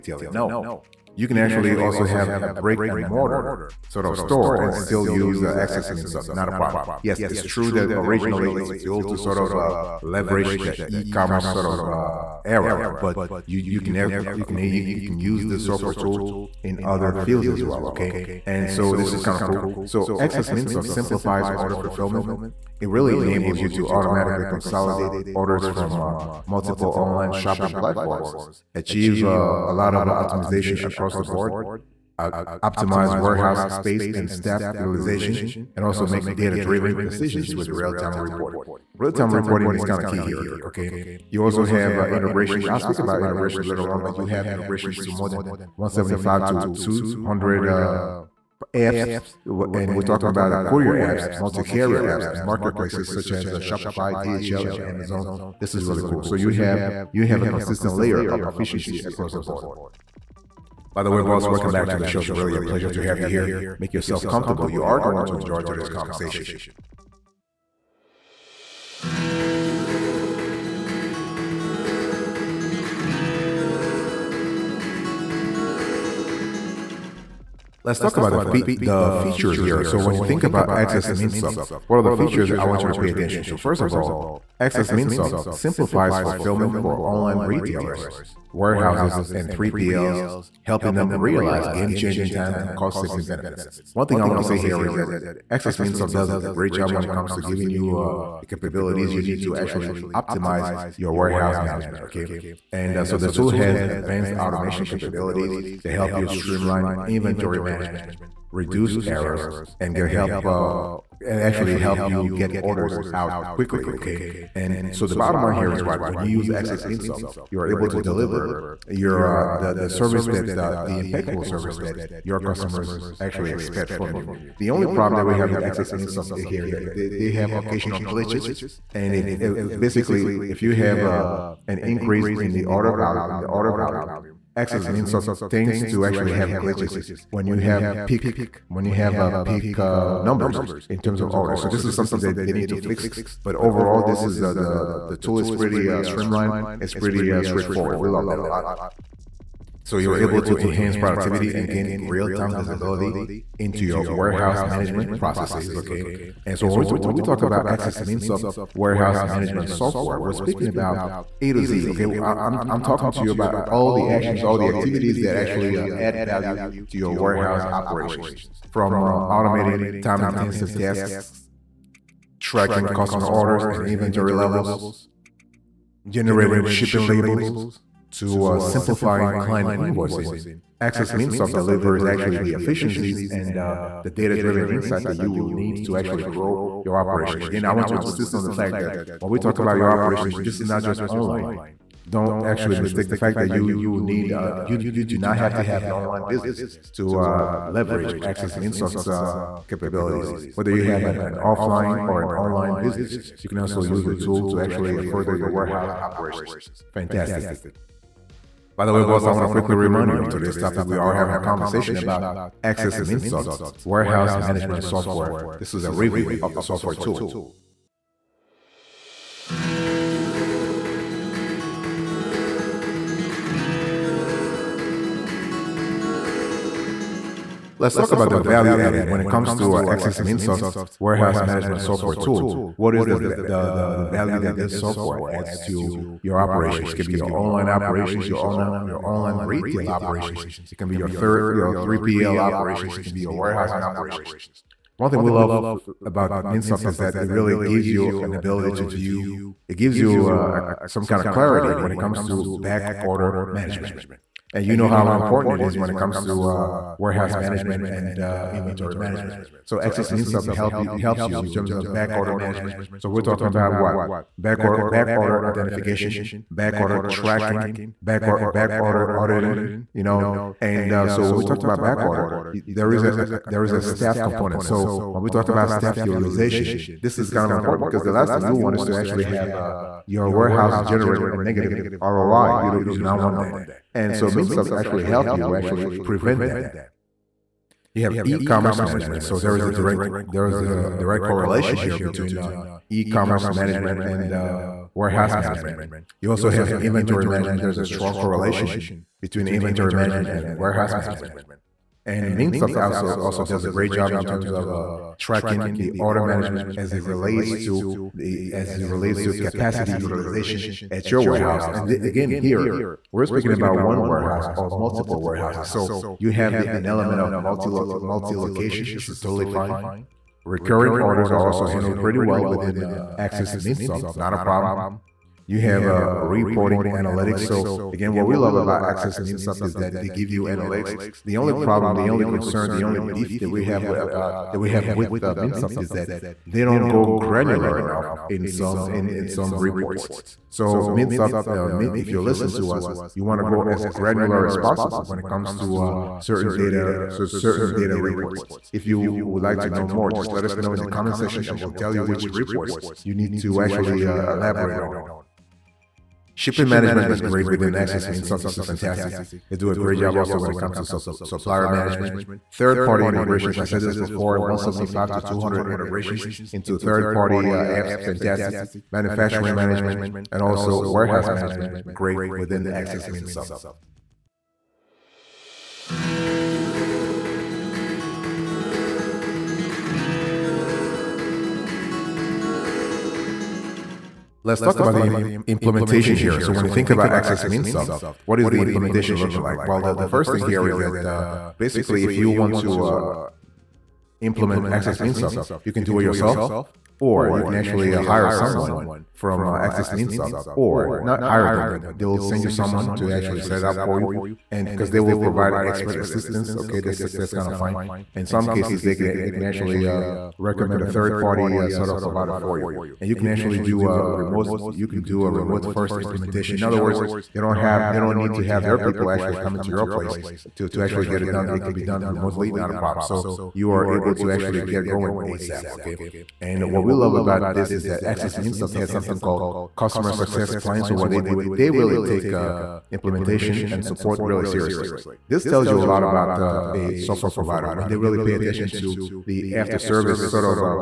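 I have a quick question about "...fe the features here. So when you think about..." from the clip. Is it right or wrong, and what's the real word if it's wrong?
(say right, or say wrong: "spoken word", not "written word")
right.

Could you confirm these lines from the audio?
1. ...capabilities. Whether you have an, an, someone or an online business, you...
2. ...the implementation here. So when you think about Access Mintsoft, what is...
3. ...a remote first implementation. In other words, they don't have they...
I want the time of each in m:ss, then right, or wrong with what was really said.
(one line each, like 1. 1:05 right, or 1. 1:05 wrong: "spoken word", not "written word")
1. 3:19 wrong: "offline", not "someone"
2. 6:24 right
3. 6:55 right.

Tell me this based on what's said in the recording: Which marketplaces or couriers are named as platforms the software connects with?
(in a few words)
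Shopify, DHL, and Amazon.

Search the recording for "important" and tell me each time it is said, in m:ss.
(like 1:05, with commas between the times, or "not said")
4:15, 4:37.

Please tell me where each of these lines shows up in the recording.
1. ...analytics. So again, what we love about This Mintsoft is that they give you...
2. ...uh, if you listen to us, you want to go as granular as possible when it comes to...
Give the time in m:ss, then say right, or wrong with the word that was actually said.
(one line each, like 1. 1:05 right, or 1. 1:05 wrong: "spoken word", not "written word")
1. 5:26 wrong: "Access", not "This"
2. 5:41 right.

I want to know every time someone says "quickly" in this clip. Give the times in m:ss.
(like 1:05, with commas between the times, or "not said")
1:53, 3:29.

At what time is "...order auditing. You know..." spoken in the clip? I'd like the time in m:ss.
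4:28.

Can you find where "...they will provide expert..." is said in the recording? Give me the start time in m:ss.
6:44.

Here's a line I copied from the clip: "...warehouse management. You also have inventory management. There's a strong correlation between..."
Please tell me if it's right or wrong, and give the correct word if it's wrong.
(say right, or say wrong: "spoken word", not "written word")
right.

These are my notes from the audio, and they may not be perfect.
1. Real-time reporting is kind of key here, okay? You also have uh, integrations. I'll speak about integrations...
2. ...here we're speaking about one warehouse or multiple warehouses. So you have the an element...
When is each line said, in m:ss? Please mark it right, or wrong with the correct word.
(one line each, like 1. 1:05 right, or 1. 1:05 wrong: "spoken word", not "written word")
1. 0:38 right
2. 5:12 right.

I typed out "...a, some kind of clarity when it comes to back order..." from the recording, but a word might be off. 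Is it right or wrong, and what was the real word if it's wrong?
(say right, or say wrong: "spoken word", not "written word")
right.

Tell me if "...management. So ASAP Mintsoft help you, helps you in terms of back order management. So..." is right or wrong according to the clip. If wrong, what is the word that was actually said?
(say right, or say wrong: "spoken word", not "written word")
wrong: "Access", not "ASAP".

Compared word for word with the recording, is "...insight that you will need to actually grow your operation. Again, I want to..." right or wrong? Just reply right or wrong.
right.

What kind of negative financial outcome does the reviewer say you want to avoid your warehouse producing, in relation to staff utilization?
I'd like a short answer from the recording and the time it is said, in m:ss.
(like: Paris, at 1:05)
Negative ROI, at 4:41.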